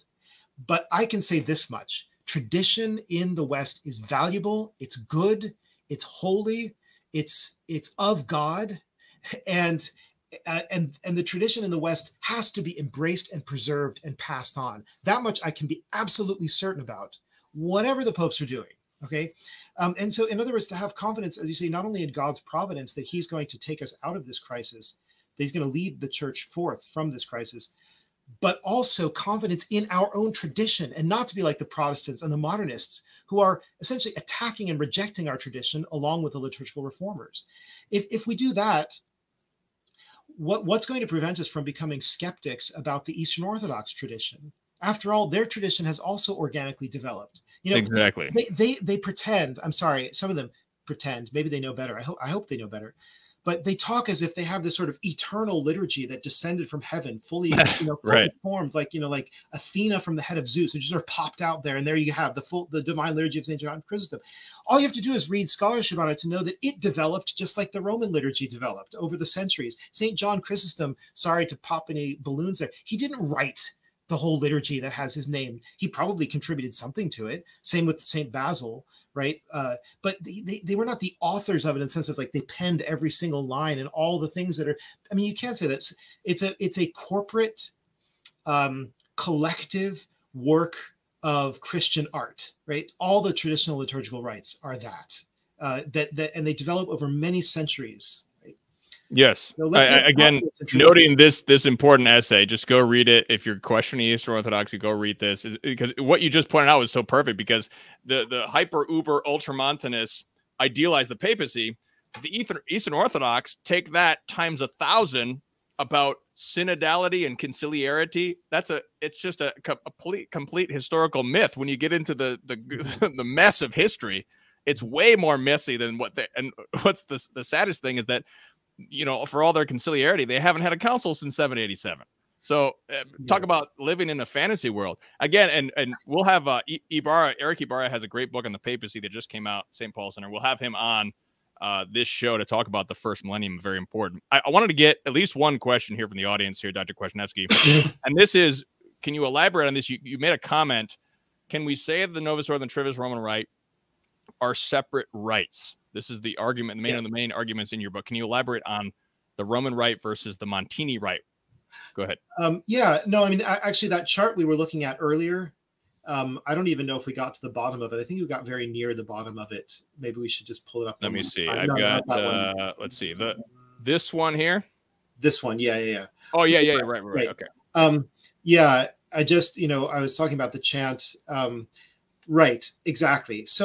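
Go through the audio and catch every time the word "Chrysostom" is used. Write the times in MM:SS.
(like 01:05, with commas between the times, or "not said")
01:03, 01:10.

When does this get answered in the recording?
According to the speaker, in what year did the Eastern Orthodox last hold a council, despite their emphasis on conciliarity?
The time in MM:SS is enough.
02:11.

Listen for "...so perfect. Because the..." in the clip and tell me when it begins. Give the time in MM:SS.
01:46.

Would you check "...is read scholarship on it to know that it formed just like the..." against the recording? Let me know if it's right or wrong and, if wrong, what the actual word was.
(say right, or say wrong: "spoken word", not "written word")
wrong: "developed", not "formed".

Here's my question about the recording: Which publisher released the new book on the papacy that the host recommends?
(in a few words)
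St. Paul Center.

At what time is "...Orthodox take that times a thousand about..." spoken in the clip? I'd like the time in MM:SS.
01:52.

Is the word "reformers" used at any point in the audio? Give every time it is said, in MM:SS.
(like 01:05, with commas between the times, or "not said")
00:36.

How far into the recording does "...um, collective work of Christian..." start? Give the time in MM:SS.
01:28.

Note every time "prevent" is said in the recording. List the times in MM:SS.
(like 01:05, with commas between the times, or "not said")
00:41.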